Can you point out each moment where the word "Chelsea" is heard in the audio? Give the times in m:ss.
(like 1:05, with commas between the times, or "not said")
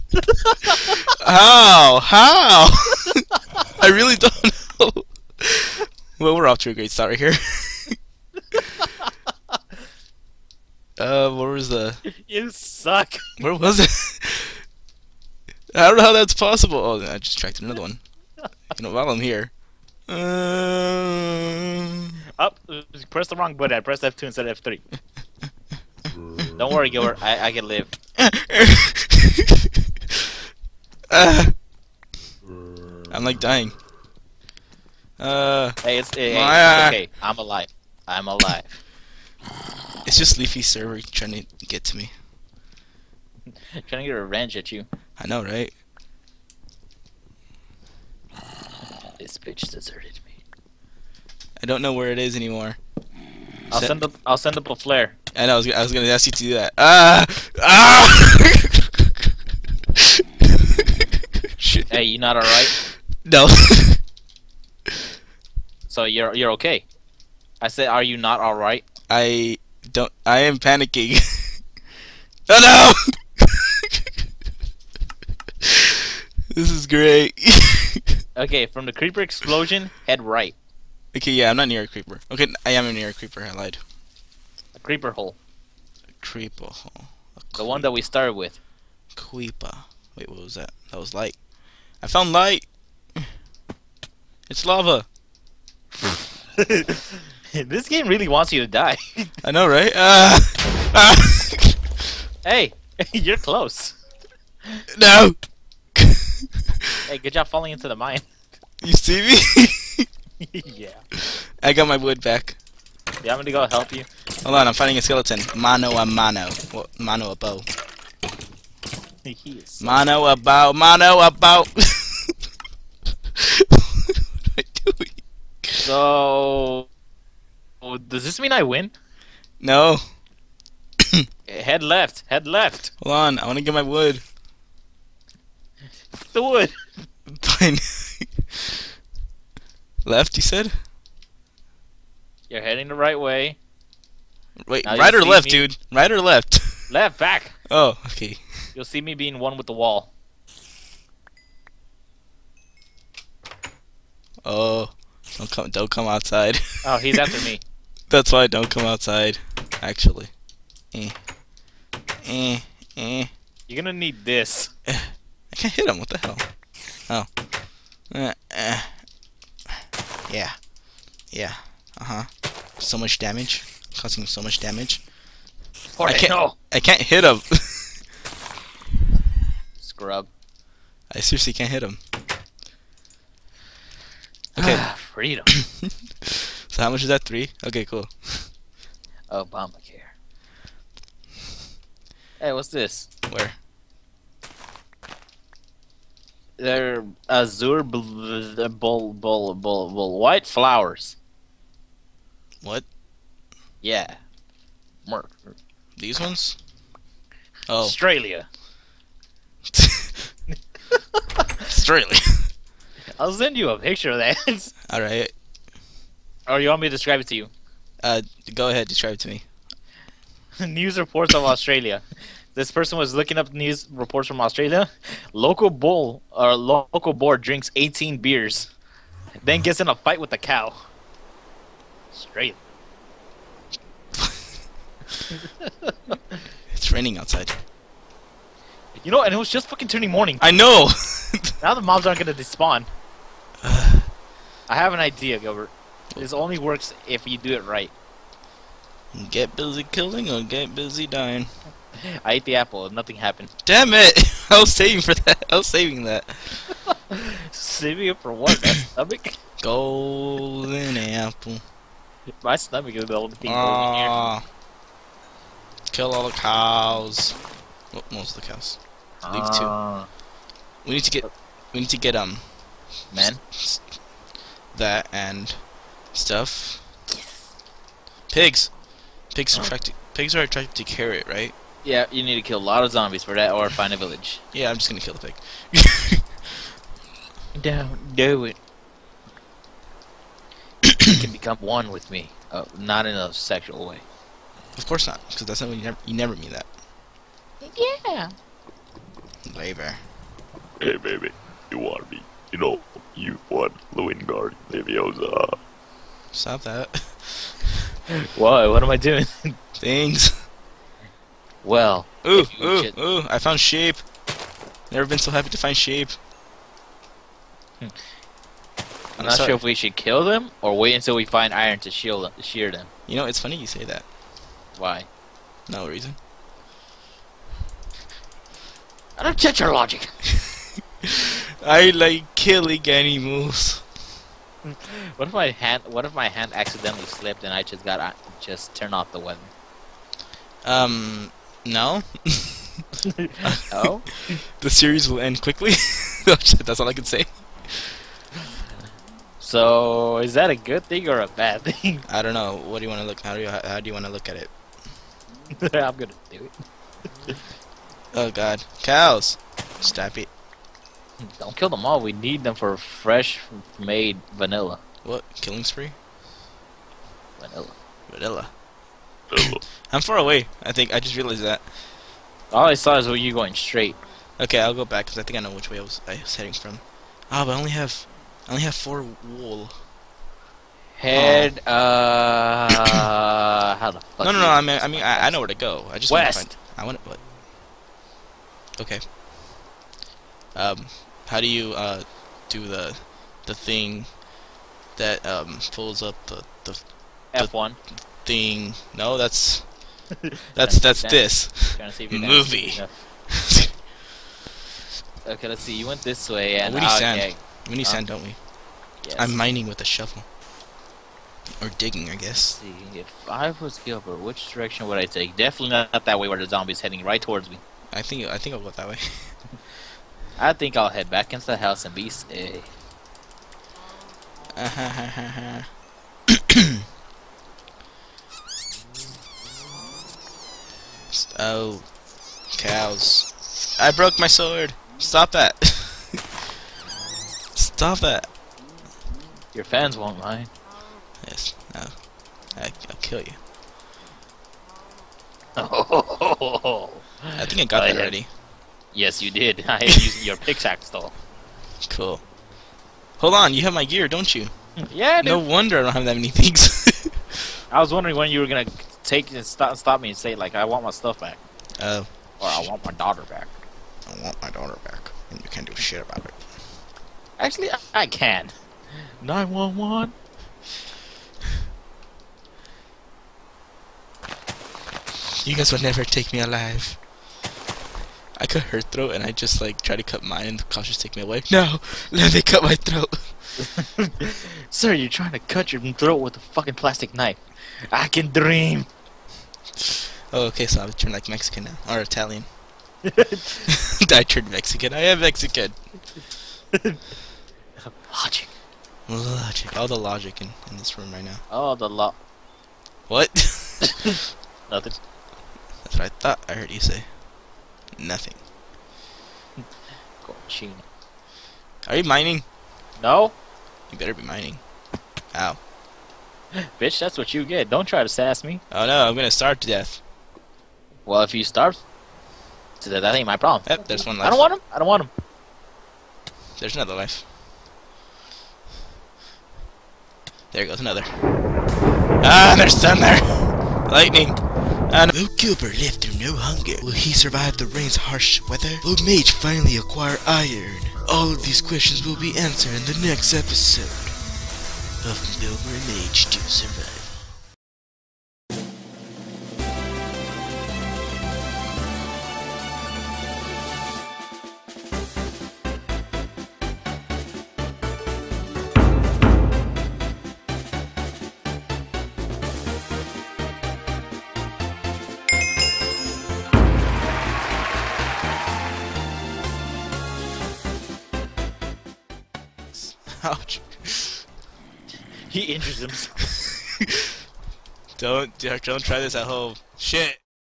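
not said.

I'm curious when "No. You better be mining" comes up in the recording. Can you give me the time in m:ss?
8:33.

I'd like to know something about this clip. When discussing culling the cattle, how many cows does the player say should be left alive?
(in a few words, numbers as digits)
2.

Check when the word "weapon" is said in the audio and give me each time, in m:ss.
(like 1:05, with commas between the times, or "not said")
5:39.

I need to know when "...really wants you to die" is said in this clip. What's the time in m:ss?
1:38.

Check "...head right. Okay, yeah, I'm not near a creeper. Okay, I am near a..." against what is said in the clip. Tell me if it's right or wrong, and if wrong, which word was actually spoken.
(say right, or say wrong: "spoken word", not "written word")
right.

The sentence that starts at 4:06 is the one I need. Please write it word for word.
This only works if you do it right.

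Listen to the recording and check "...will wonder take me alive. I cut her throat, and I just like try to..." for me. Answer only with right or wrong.
wrong.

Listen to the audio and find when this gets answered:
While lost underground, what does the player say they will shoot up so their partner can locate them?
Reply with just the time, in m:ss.
0:54.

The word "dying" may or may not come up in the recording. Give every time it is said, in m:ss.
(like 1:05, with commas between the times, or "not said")
0:33, 4:11.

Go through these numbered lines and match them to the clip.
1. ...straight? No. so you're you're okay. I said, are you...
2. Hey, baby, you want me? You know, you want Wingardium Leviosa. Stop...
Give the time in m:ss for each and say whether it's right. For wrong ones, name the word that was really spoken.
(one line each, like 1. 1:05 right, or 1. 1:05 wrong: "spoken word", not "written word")
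1. 1:02 wrong: "alright", not "straight"
2. 5:00 right.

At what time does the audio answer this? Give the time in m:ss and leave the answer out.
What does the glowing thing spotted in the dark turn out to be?
1:34.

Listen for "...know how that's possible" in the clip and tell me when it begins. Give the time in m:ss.
0:15.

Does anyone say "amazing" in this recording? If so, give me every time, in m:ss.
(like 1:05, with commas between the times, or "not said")
not said.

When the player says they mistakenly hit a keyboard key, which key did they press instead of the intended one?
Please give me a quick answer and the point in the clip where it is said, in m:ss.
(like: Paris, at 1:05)
F2, at 0:23.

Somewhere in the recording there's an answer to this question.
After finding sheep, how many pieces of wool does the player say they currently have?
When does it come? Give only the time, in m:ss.
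6:18.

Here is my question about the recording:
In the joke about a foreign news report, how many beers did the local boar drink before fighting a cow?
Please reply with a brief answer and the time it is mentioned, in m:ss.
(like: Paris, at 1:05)
18, at 3:47.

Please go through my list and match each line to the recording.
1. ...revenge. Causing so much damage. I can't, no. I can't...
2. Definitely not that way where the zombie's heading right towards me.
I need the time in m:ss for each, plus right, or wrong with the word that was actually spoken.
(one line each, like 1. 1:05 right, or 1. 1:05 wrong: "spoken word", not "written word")
1. 2:53 wrong: "damage", not "revenge"
2. 6:55 right.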